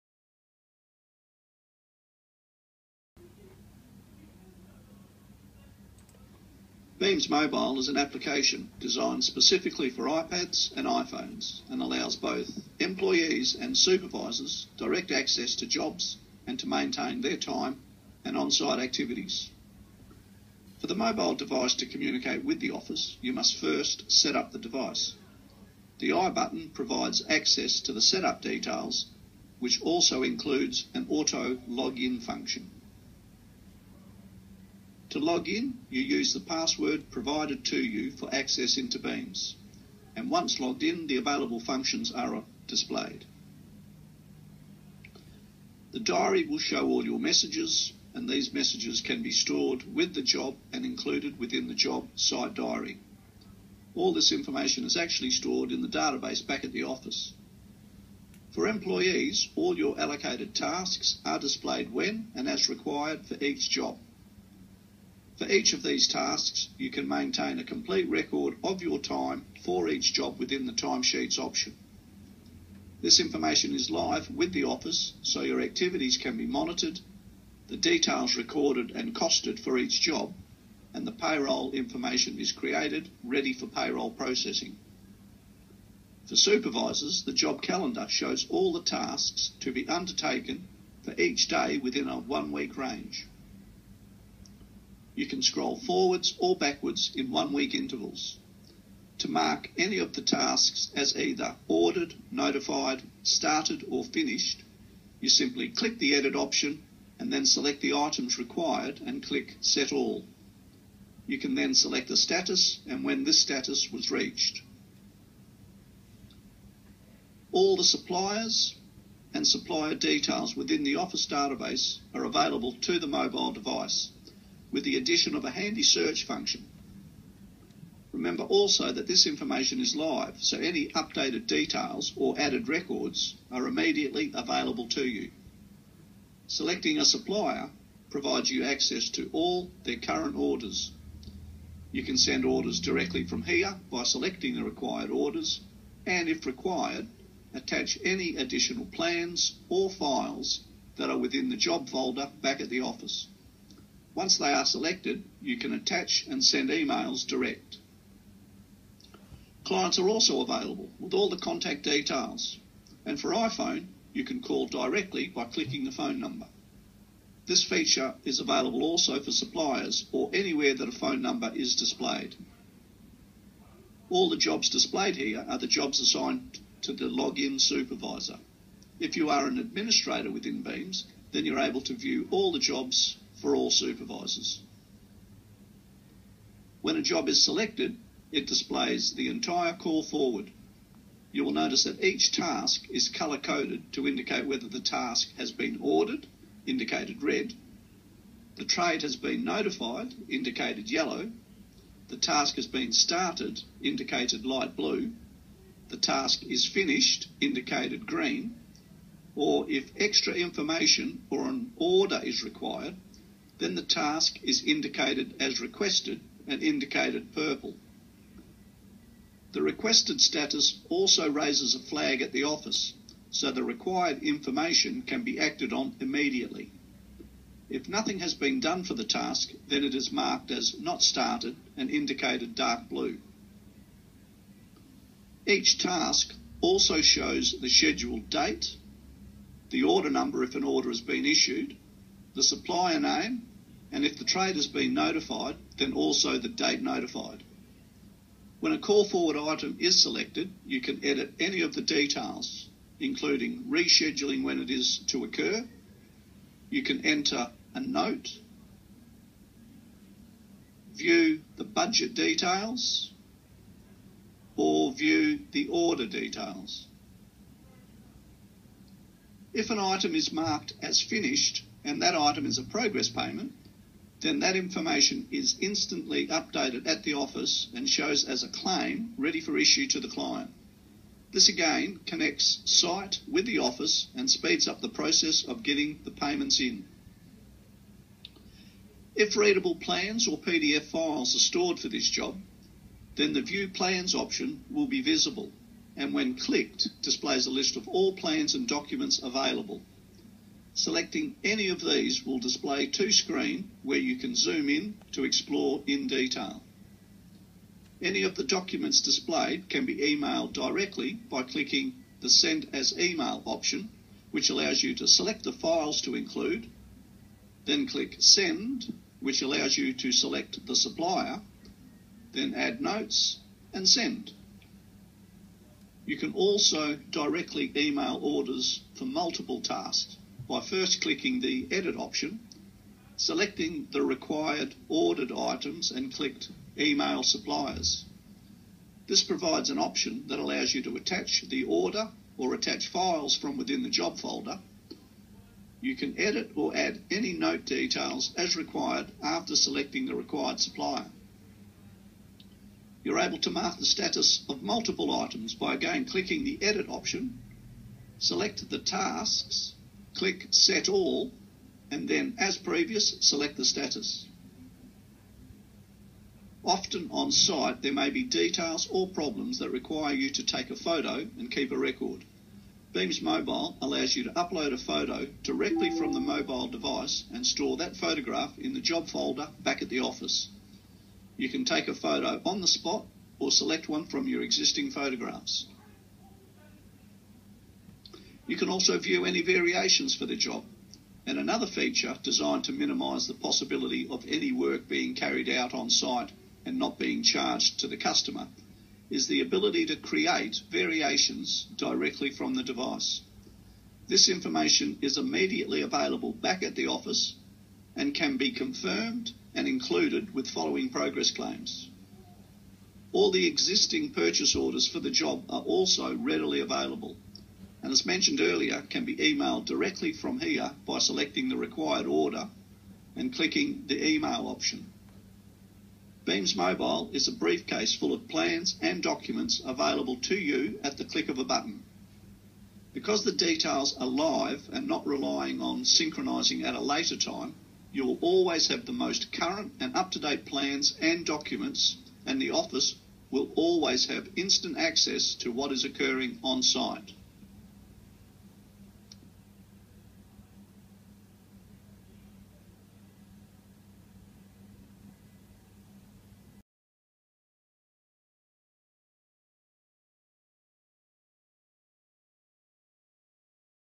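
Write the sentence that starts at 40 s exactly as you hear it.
And once logged in, the available functions are displayed.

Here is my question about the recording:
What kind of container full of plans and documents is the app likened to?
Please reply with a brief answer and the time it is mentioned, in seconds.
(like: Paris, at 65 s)
A briefcase, at 427 s.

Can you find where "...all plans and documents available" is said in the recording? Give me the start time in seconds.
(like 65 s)
297 s.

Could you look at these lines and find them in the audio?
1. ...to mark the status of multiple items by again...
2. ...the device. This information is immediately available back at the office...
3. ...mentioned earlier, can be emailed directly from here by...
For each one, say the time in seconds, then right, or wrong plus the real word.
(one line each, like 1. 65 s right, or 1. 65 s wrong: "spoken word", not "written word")
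1. 353 s right
2. 402 s right
3. 418 s right.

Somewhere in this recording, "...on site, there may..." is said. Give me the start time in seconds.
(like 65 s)
367 s.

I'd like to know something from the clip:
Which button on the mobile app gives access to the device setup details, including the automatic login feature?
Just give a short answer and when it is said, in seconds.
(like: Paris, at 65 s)
I button, at 26 s.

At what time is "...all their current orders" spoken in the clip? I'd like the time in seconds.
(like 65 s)
139 s.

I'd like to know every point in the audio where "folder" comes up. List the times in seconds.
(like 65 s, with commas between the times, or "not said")
151 s, 344 s, 379 s.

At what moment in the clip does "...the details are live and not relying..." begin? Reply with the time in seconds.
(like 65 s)
433 s.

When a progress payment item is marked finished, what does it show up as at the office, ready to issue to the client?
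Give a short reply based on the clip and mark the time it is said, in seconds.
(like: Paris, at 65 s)
A claim, at 278 s.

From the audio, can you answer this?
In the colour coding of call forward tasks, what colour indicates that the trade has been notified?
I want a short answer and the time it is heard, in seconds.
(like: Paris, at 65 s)
Yellow, at 200 s.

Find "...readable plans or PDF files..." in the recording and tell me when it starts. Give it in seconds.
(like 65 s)
289 s.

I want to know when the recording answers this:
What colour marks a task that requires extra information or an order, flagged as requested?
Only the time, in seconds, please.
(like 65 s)
216 s.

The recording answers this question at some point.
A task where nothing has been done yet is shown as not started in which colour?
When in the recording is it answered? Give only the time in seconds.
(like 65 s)
232 s.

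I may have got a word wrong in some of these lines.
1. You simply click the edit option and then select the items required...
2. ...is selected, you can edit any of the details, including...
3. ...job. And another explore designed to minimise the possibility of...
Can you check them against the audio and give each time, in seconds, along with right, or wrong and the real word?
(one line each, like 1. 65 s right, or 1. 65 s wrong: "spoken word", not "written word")
1. 105 s right
2. 249 s right
3. 390 s wrong: "feature", not "explore".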